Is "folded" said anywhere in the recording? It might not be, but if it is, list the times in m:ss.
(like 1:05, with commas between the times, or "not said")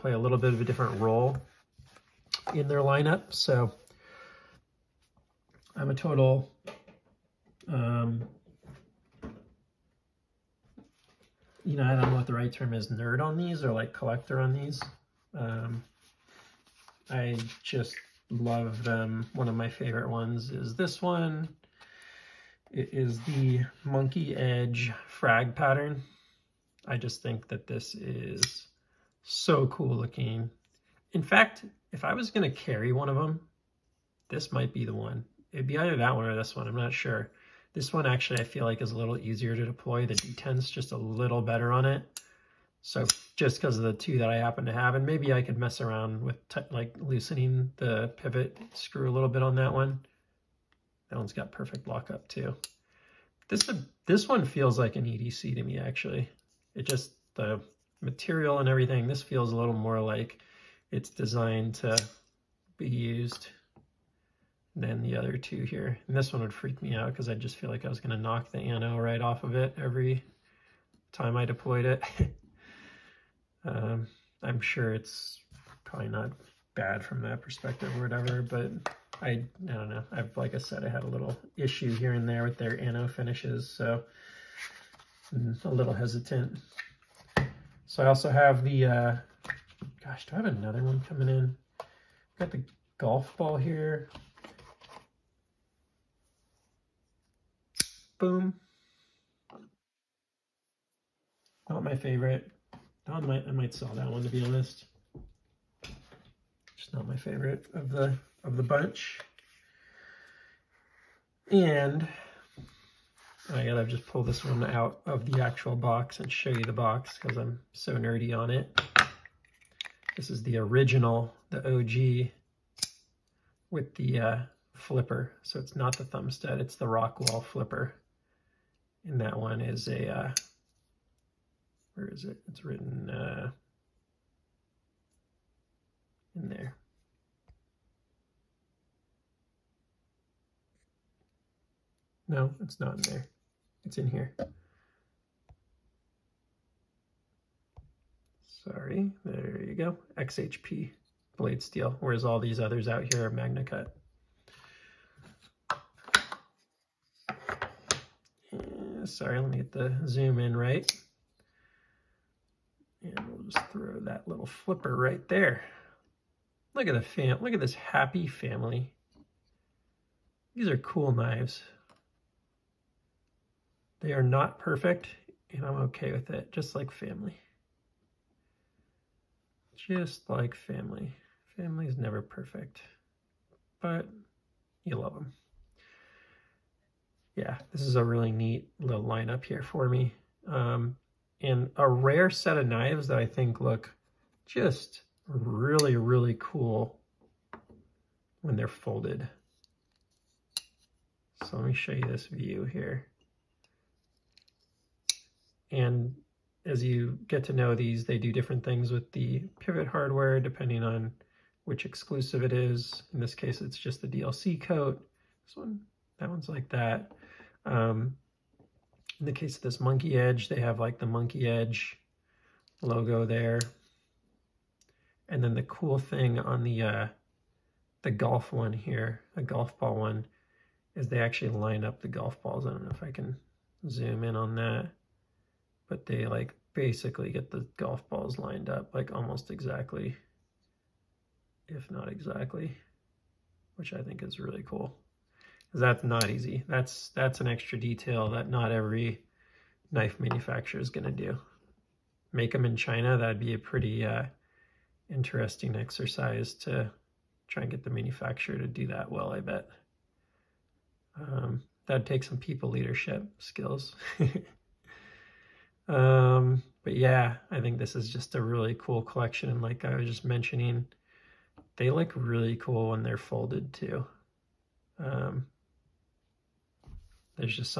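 3:18, 4:33.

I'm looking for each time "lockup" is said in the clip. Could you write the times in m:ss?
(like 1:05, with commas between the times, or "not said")
0:51.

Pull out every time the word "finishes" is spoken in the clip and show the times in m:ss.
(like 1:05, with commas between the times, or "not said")
1:23.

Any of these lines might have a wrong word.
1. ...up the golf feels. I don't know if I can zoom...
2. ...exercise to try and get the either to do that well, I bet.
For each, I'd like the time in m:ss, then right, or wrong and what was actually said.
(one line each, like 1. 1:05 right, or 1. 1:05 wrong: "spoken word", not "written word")
1. 3:51 wrong: "balls", not "feels"
2. 4:15 wrong: "manufacturer", not "either".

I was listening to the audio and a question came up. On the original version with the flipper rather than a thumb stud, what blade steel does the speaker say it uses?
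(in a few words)
XHP.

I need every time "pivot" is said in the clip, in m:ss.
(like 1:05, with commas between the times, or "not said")
0:48, 3:29.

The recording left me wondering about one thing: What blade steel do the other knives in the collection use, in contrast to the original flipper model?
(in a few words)
MagnaCut.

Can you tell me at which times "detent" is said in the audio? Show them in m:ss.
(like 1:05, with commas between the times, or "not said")
0:40.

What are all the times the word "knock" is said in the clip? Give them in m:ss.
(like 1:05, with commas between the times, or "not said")
1:08.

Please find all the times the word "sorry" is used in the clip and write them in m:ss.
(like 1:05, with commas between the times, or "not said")
2:28, 2:39.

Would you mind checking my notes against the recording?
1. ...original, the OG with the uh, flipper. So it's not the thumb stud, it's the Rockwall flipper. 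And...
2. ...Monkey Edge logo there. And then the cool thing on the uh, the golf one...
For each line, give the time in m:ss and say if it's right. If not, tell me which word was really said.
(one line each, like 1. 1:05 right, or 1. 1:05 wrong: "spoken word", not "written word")
1. 2:00 right
2. 3:41 right.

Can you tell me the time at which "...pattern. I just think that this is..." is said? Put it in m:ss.
0:25.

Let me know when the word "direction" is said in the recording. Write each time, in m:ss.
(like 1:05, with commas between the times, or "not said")
not said.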